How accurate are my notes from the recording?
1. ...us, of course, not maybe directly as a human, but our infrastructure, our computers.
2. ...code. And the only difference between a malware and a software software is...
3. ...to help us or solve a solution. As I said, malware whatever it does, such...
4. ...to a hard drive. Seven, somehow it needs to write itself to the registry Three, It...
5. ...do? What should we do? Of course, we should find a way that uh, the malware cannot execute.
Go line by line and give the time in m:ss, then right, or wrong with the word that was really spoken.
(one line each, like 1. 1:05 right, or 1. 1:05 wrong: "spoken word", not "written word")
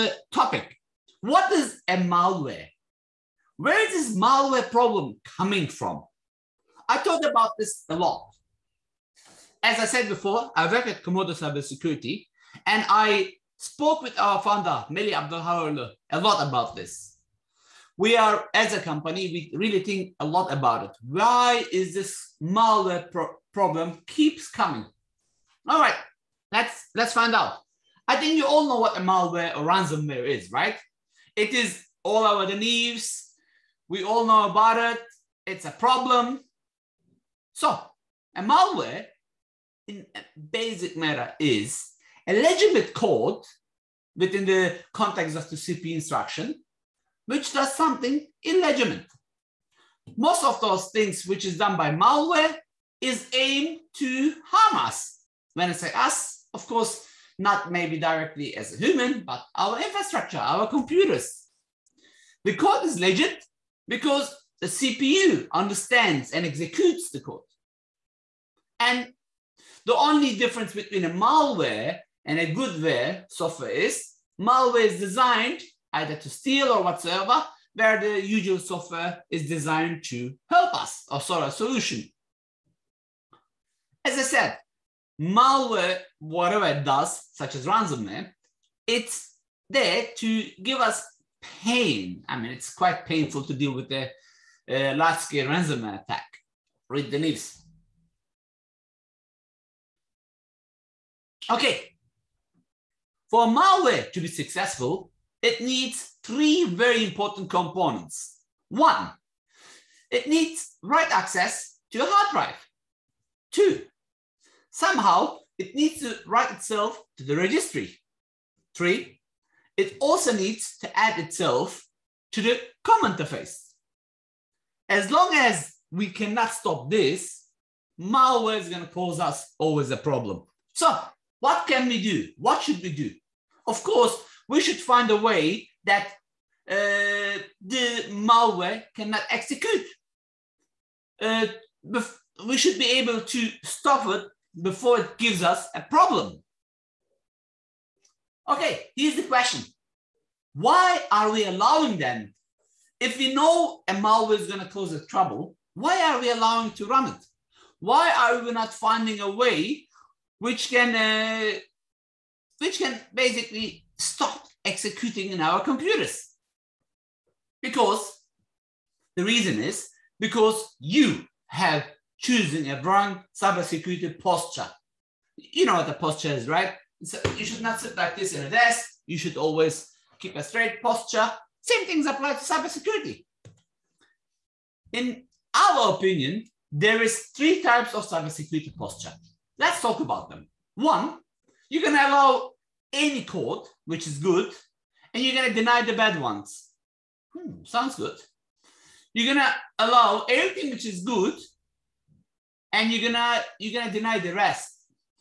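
1. 0:55 right
2. 1:07 wrong: "goodware", not "software"
3. 1:20 right
4. 1:51 wrong: "Two", not "Seven"
5. 2:12 right.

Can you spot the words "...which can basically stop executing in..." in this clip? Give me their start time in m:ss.
2:42.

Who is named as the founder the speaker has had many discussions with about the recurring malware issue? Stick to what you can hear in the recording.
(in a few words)
Melih Abdulhayoğlu.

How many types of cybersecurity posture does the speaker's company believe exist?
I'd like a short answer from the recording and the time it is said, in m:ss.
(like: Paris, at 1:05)
3, at 3:07.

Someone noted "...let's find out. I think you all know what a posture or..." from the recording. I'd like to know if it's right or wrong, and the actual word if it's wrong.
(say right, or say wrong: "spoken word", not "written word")
wrong: "malware", not "posture".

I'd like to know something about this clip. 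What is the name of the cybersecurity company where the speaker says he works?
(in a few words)
Comodo Cybersecurity.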